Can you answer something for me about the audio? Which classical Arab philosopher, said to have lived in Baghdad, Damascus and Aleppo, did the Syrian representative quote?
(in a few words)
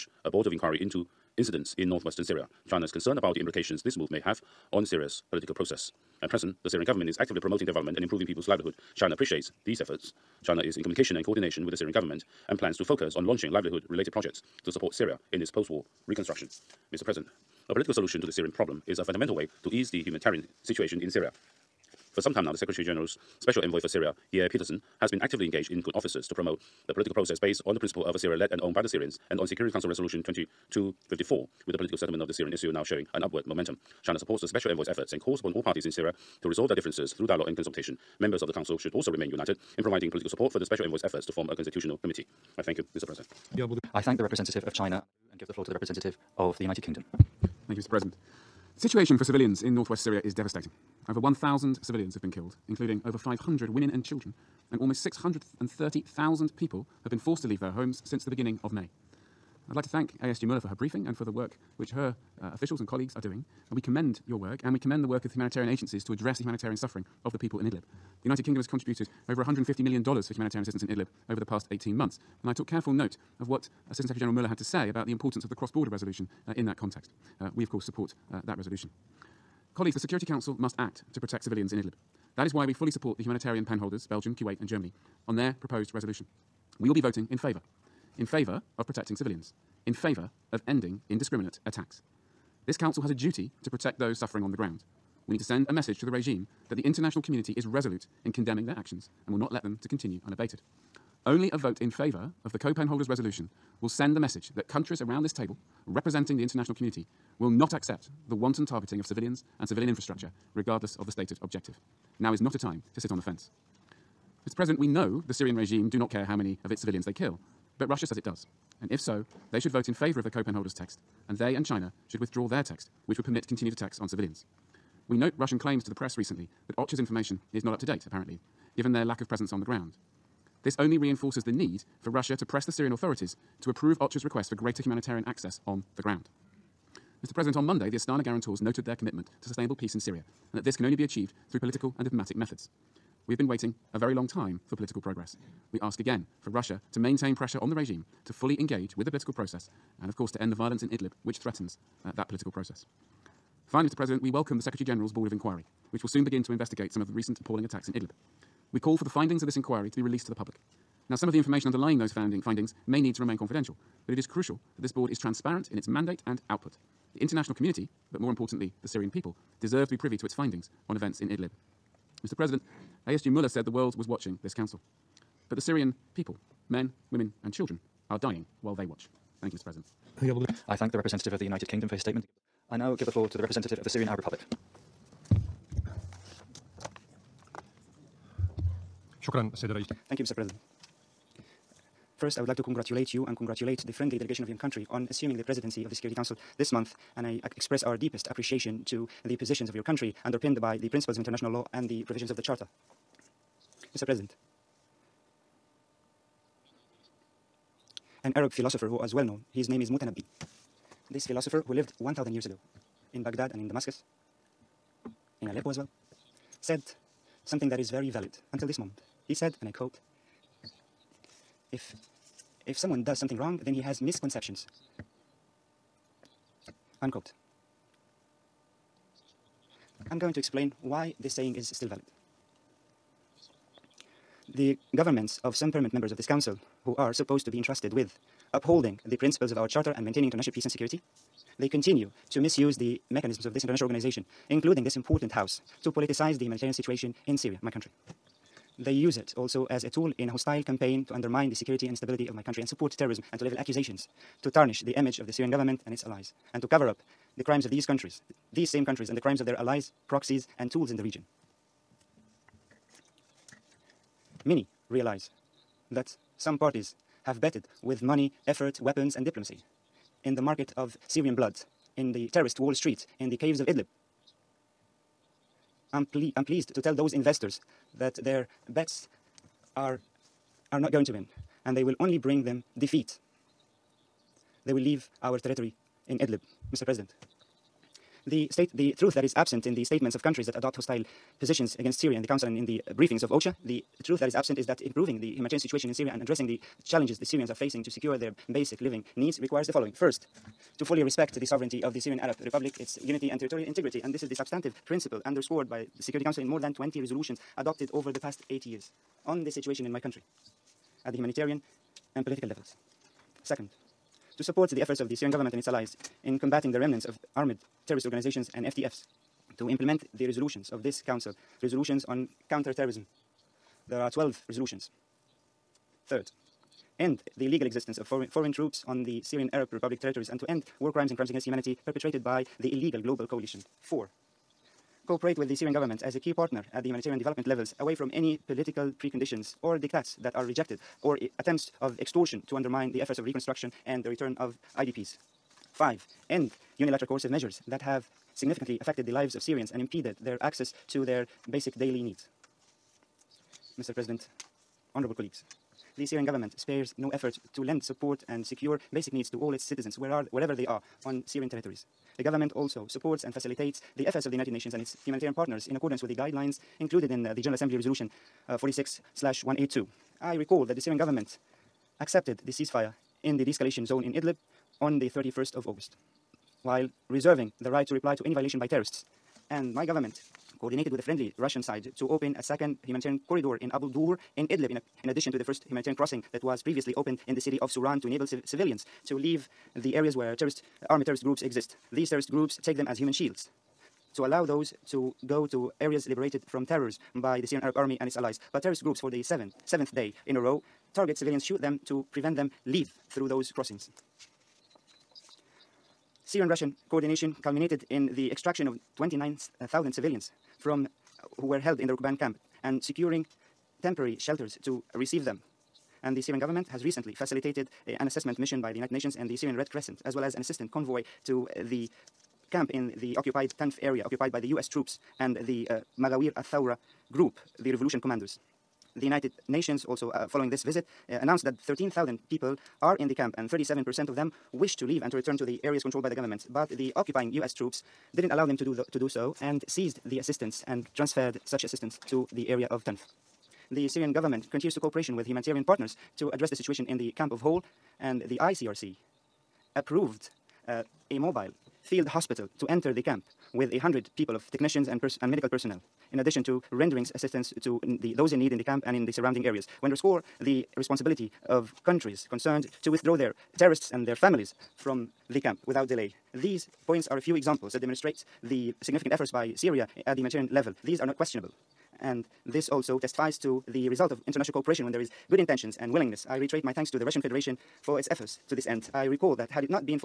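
Mutanabbi.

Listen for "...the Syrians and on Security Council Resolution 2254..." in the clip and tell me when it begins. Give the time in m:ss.
0:28.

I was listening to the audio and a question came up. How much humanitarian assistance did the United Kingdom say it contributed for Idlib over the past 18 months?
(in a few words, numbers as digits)
$150 million.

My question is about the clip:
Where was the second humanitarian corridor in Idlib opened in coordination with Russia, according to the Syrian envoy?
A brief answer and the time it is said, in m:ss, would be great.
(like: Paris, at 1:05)
Abu Dur, at 6:23.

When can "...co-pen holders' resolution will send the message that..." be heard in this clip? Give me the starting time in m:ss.
1:42.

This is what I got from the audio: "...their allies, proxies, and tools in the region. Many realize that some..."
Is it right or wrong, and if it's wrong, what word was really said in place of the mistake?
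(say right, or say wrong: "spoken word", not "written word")
right.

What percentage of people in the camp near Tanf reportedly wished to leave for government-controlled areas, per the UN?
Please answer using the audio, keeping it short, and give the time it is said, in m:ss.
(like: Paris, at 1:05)
37%, at 7:13.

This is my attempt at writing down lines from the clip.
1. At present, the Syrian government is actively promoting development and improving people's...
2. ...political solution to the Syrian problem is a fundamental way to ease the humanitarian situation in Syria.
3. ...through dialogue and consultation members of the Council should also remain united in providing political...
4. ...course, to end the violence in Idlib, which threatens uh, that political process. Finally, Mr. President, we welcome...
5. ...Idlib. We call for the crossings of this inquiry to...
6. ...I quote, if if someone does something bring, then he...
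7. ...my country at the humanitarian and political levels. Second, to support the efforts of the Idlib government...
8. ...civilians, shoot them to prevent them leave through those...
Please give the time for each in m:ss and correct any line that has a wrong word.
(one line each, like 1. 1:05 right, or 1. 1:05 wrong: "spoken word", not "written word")
1. 0:06 right
2. 0:17 right
3. 0:37 right
4. 2:30 right
5. 2:37 wrong: "findings", not "crossings"
6. 3:39 wrong: "wrong", not "bring"
7. 5:09 wrong: "Syrian", not "Idlib"
8. 6:41 right.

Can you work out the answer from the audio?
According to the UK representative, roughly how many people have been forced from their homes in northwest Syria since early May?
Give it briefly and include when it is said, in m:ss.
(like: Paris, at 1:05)
630,000, at 0:55.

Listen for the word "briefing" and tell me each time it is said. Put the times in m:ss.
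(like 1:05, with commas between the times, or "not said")
1:00, 4:52.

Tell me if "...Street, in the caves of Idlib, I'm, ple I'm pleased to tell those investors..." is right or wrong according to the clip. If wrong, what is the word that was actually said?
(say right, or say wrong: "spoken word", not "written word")
right.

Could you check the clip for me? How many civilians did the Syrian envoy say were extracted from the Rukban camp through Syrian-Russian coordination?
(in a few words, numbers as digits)
29,000.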